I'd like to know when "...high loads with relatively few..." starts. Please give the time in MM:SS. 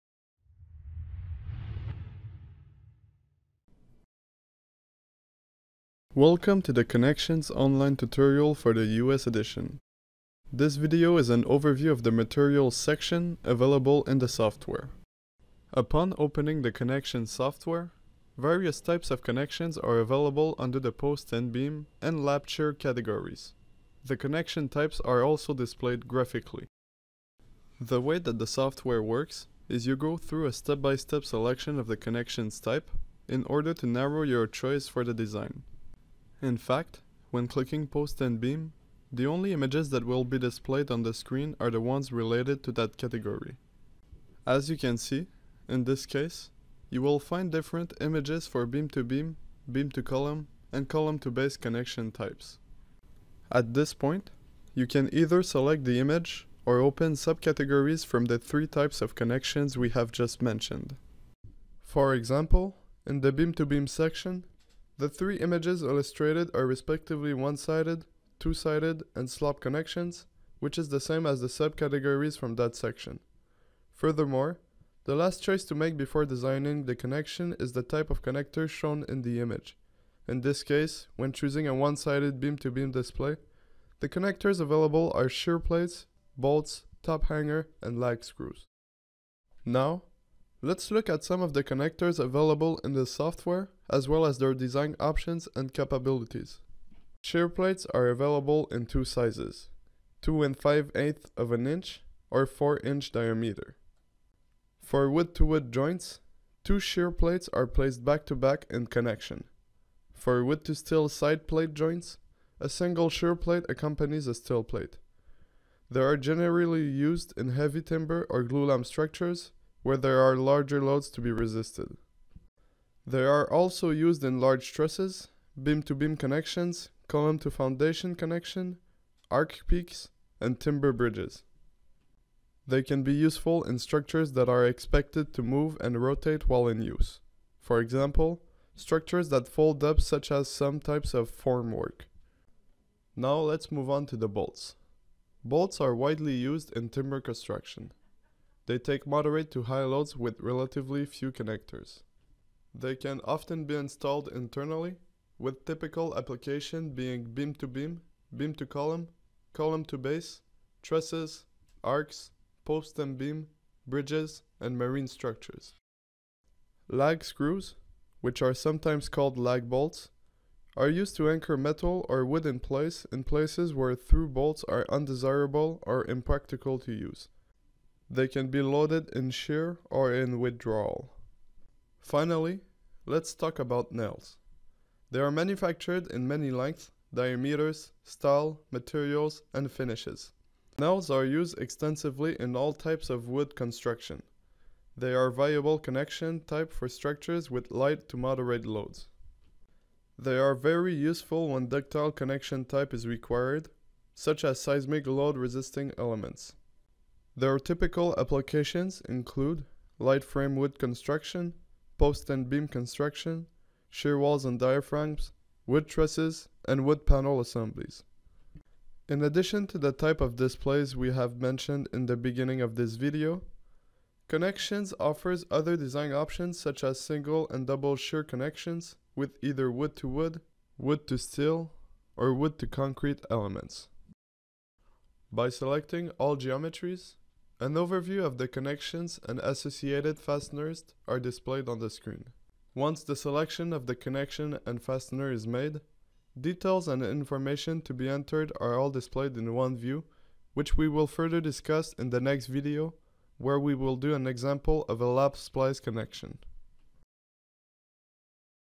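02:29.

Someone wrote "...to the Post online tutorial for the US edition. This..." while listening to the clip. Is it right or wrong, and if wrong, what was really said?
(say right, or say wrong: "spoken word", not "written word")
wrong: "Connections", not "Post".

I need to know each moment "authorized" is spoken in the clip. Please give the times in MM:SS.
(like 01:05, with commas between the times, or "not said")
not said.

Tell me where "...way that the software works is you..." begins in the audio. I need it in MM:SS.
00:28.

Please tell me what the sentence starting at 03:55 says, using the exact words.
By selecting all geometries, an overview of the connections and associated fasteners are displayed on the screen.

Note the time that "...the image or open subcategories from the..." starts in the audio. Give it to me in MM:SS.
00:55.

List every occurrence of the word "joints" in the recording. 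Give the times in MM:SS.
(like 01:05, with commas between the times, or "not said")
01:45, 01:51.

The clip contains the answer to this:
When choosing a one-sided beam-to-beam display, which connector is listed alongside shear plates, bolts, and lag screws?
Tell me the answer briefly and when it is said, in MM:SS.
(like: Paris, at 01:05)
top hanger, at 01:27.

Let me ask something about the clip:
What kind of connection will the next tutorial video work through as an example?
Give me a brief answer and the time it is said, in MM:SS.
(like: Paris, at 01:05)
lap splice connection, at 04:15.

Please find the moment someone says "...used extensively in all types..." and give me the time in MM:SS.
03:11.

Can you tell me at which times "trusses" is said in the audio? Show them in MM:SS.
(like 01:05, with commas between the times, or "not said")
02:04, 02:40, 03:35.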